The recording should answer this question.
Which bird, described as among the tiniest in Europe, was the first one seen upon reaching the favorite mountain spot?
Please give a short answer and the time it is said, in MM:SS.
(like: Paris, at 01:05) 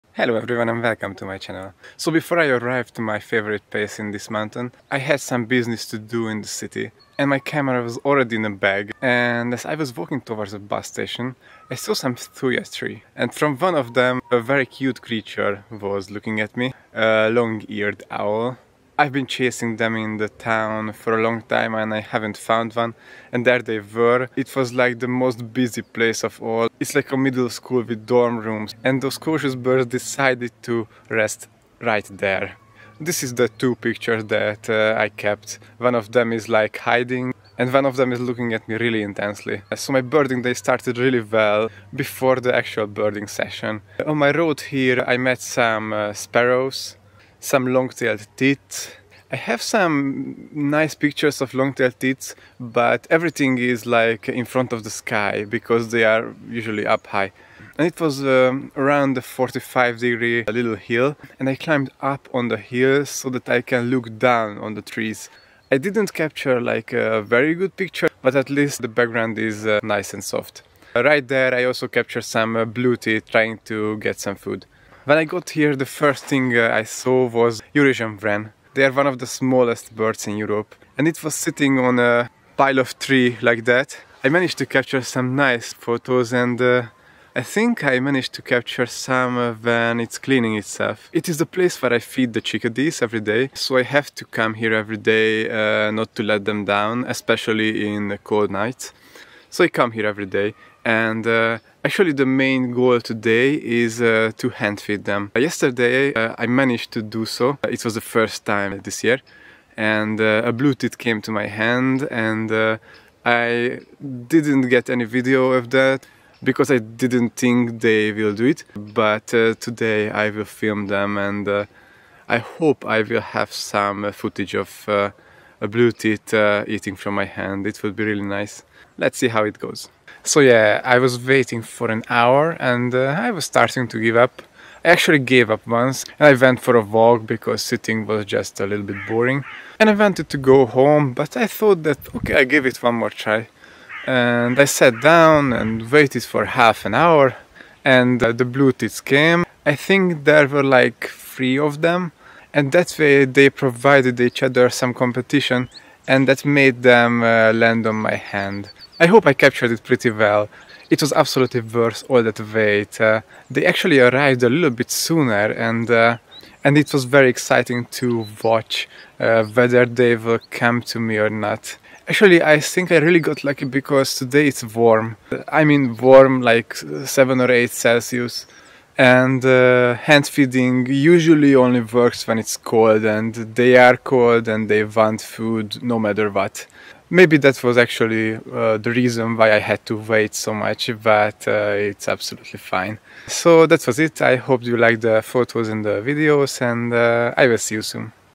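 Eurasian wren, at 01:17.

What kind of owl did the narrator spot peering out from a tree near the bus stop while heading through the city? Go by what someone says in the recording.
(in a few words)
long-eared owl.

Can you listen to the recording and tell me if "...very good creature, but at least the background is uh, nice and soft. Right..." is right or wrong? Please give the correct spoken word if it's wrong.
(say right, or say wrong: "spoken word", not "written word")
wrong: "picture", not "creature".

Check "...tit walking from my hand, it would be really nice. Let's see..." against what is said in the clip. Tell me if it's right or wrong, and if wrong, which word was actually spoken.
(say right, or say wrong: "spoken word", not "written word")
wrong: "eating", not "walking".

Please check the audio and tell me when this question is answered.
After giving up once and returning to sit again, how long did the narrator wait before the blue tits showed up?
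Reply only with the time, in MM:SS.
02:26.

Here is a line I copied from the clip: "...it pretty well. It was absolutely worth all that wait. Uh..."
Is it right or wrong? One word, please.
right.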